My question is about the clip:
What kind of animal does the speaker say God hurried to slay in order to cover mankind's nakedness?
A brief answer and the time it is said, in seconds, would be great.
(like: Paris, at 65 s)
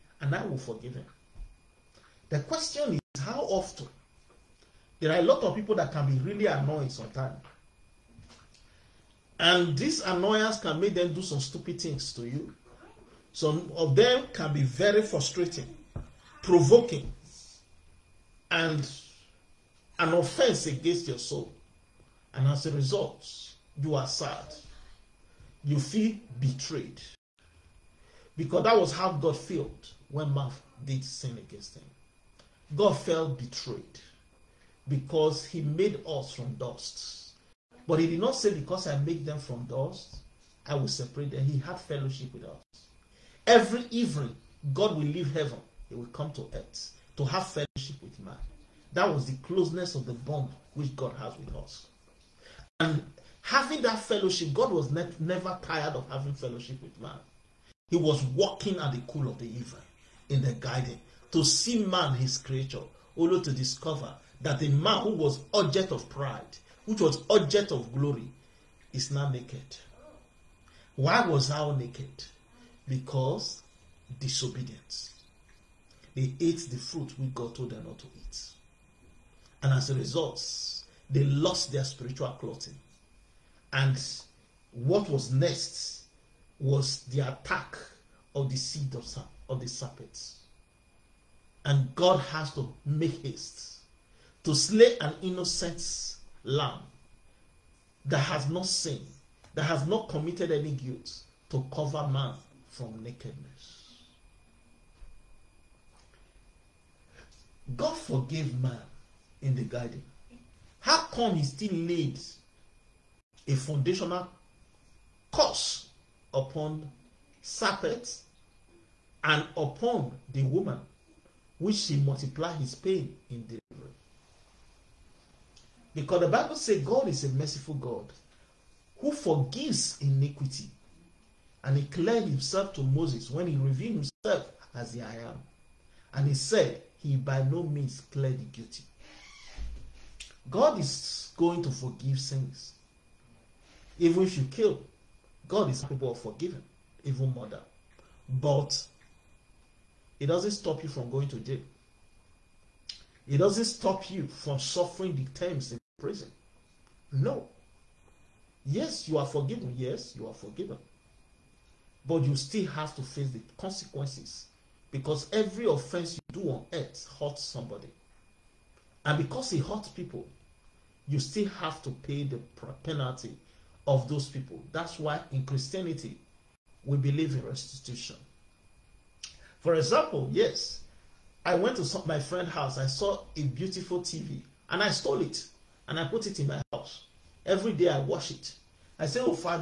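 an innocent lamb, at 95 s.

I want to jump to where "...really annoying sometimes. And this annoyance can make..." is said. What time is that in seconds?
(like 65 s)
6 s.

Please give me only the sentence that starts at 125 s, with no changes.
Because the Bible says God is a merciful God who forgives iniquity.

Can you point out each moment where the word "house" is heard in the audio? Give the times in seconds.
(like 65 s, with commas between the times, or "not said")
182 s, 186 s.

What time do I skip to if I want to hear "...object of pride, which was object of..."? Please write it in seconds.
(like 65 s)
65 s.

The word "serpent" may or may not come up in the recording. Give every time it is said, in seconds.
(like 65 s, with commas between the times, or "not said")
89 s, 117 s.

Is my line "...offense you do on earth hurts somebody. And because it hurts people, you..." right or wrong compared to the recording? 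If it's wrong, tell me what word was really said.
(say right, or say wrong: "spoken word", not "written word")
right.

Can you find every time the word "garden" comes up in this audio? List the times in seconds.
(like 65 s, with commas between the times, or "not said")
60 s, 109 s.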